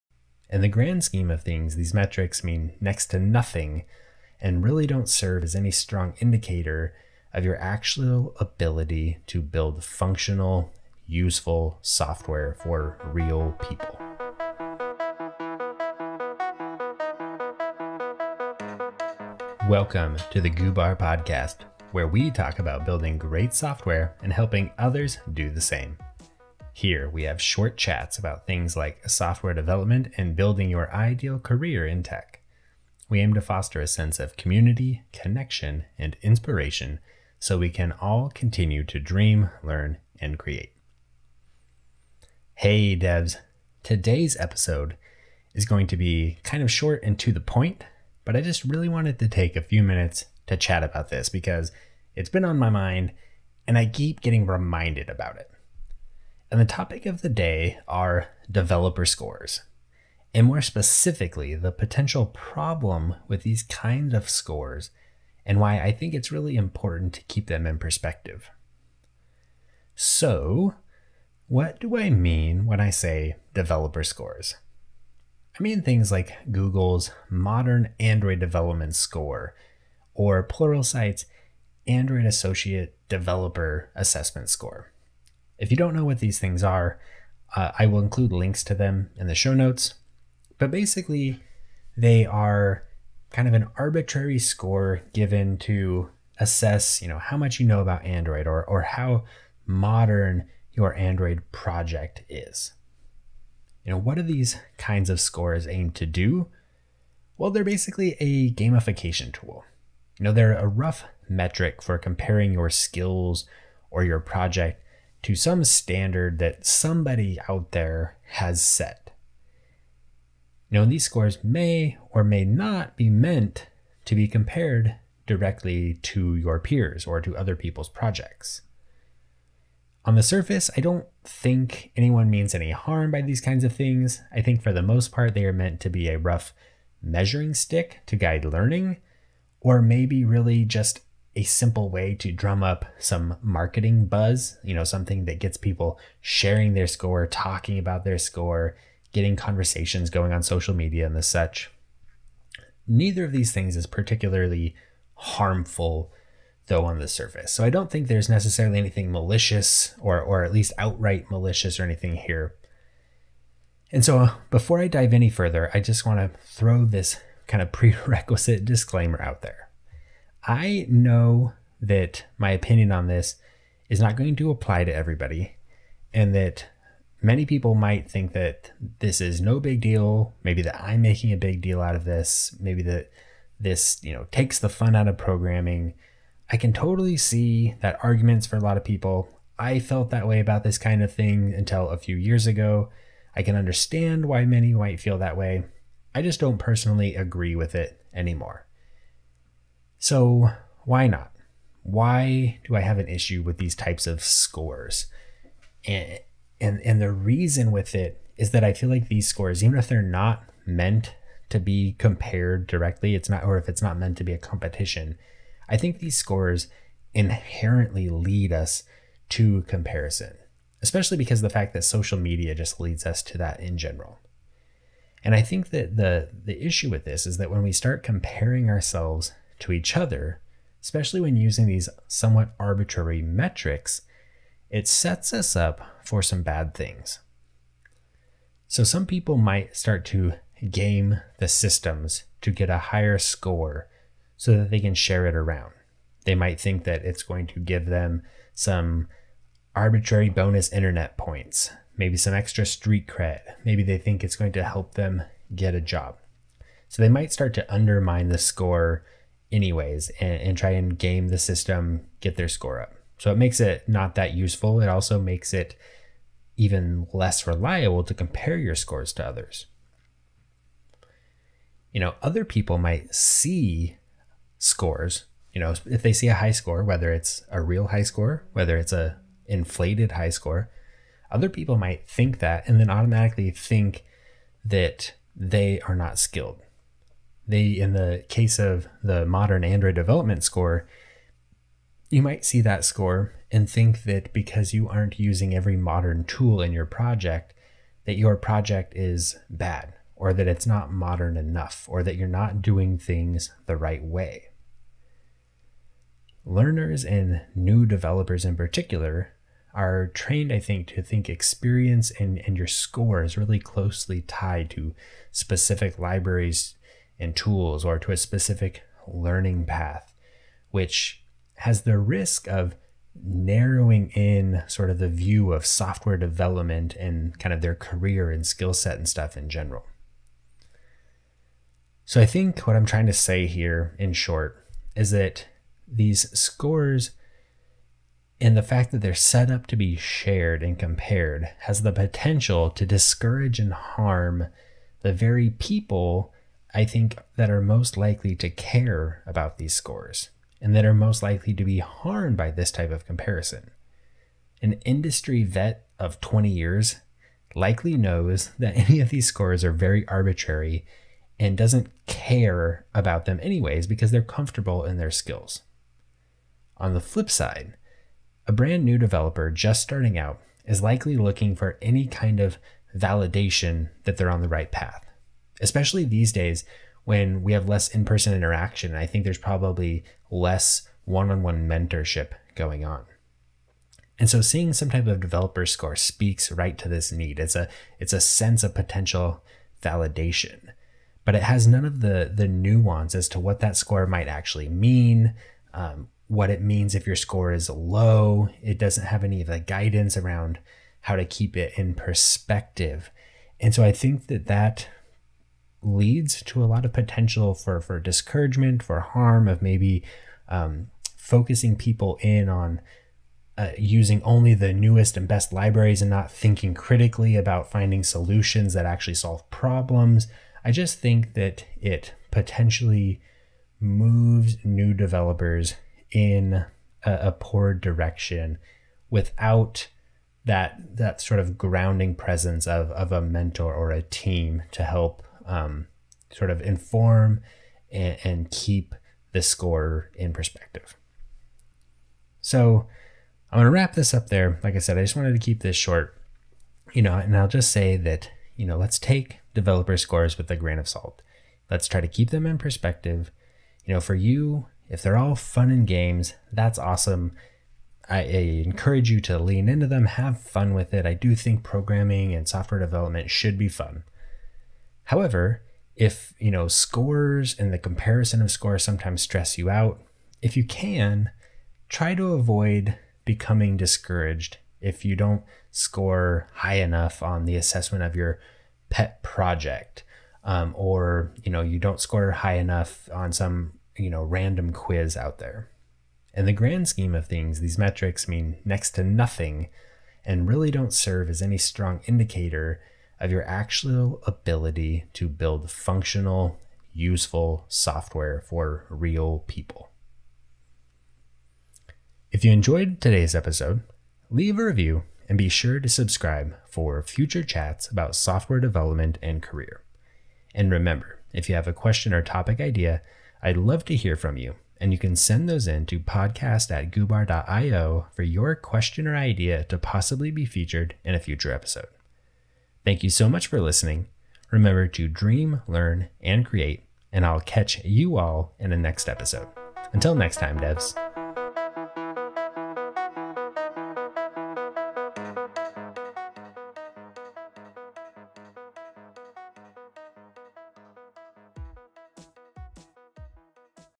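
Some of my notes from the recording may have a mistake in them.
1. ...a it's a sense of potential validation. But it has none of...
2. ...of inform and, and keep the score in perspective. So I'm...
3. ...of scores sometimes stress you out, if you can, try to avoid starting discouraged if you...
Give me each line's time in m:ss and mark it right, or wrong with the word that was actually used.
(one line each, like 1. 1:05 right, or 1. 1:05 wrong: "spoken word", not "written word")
1. 6:27 right
2. 7:16 right
3. 7:48 wrong: "becoming", not "starting".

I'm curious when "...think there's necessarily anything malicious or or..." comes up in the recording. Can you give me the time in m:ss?
2:37.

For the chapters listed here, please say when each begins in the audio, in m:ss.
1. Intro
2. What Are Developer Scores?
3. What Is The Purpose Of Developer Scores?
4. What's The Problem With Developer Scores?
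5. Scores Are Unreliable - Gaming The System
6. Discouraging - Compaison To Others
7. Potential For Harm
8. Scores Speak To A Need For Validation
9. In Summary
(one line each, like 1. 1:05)
1. 0:42
2. 1:09
3. 2:09
4. 3:19
5. 3:58
6. 4:31
7. 5:31
8. 6:06
9. 7:23.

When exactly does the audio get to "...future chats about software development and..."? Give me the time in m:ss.
8:27.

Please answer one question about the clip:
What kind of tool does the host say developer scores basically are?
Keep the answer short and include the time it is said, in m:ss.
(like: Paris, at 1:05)
A gamification tool, at 1:48.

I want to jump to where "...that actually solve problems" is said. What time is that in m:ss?
6:58.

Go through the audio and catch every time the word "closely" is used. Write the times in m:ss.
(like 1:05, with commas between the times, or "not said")
5:13.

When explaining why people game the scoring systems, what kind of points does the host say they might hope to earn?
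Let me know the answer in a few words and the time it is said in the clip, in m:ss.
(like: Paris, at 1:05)
Bonus internet points, at 4:10.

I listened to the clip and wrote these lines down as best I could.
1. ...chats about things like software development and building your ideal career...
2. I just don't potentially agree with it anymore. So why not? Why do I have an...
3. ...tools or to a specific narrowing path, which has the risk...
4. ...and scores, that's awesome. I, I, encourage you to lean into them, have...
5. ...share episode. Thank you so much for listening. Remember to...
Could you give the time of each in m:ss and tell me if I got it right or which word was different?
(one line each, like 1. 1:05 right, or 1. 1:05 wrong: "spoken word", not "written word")
1. 0:27 right
2. 3:16 wrong: "personally", not "potentially"
3. 5:17 wrong: "learning", not "narrowing"
4. 7:35 wrong: "games", not "scores"
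5. 8:41 wrong: "future", not "share".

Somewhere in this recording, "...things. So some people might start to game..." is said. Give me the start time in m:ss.
3:56.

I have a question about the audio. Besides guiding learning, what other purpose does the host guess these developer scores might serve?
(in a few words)
Marketing buzz.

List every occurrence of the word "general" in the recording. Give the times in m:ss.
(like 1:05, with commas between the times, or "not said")
3:43, 5:29.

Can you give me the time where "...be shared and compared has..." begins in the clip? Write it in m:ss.
5:39.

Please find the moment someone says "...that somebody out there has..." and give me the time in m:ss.
1:56.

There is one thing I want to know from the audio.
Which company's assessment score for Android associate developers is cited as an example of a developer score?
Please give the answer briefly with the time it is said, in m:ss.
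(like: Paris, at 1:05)
Pluralsight, at 1:20.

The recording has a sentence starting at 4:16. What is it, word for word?
So they might start to undermine the score anyways and, and try and game the system, get their score up.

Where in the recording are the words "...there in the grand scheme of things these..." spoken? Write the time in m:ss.
8:05.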